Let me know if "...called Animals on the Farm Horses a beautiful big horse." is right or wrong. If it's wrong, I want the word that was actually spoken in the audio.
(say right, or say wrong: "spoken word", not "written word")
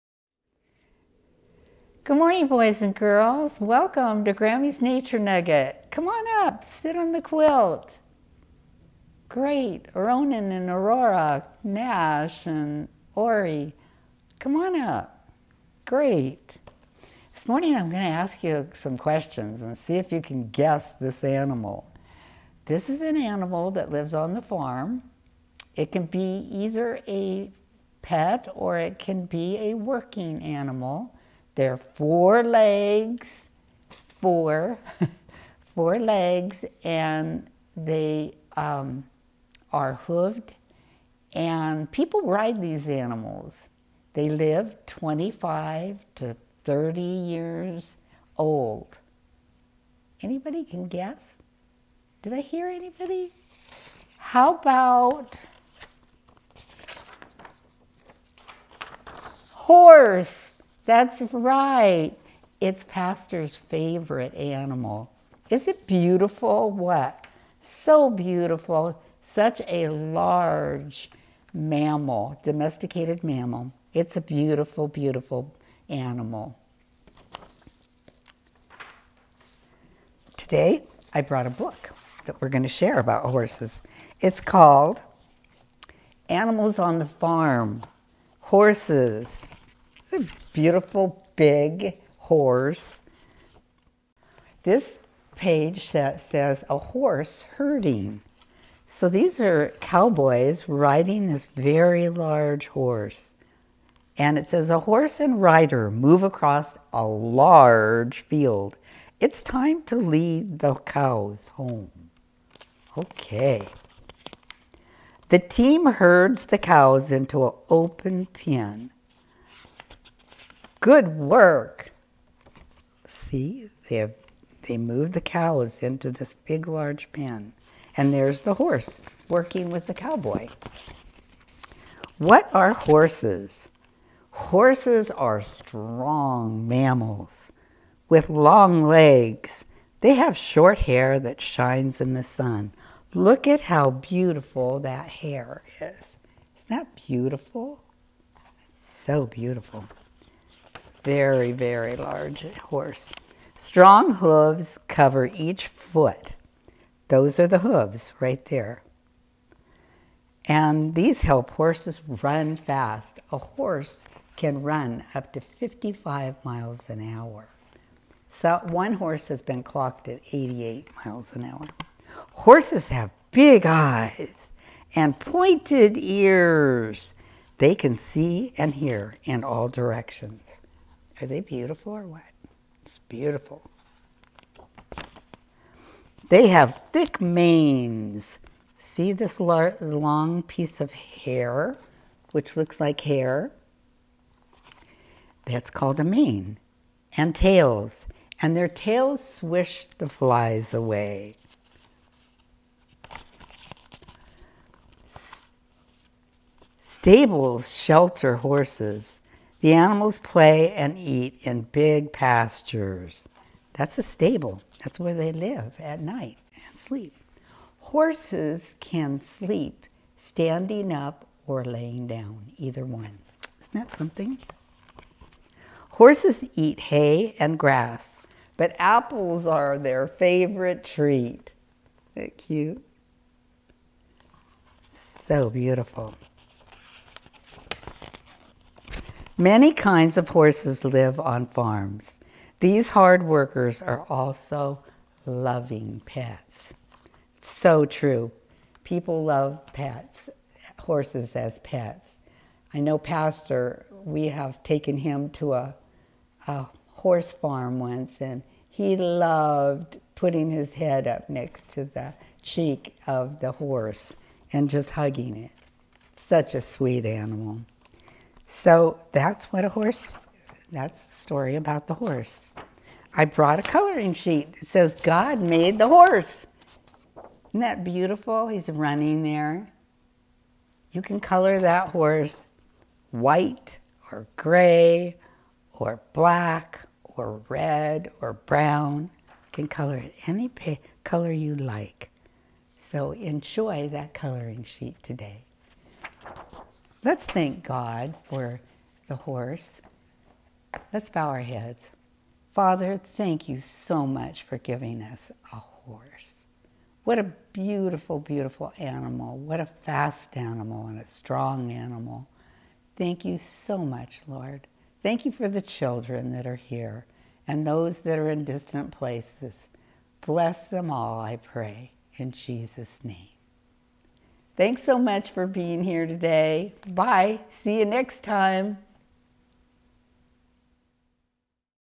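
right.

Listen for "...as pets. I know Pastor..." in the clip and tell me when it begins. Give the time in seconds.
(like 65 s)
251 s.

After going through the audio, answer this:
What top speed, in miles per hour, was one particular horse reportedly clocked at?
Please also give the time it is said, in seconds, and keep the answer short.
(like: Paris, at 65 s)
88 miles an hour, at 170 s.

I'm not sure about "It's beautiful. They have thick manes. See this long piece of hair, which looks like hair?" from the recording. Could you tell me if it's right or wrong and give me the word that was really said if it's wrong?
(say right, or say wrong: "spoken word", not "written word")
right.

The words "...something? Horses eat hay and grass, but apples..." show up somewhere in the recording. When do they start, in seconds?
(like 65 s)
223 s.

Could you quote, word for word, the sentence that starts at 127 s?
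And there's the horse working with the cowboy.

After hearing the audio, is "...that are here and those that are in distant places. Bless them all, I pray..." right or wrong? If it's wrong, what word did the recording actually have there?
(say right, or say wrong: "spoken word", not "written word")
right.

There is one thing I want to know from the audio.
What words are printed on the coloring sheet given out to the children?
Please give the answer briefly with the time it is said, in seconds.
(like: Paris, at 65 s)
God made the horse, at 274 s.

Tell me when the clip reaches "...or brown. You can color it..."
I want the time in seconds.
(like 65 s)
288 s.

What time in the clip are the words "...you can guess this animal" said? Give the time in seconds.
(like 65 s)
20 s.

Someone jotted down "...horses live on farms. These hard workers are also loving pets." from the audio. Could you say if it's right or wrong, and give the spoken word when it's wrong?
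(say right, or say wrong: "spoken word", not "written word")
right.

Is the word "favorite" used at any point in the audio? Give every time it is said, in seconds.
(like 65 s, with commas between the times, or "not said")
63 s, 230 s.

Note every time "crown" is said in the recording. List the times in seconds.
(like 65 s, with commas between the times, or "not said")
not said.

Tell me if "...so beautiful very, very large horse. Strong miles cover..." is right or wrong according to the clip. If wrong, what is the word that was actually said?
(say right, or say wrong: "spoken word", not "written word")
wrong: "hooves", not "miles".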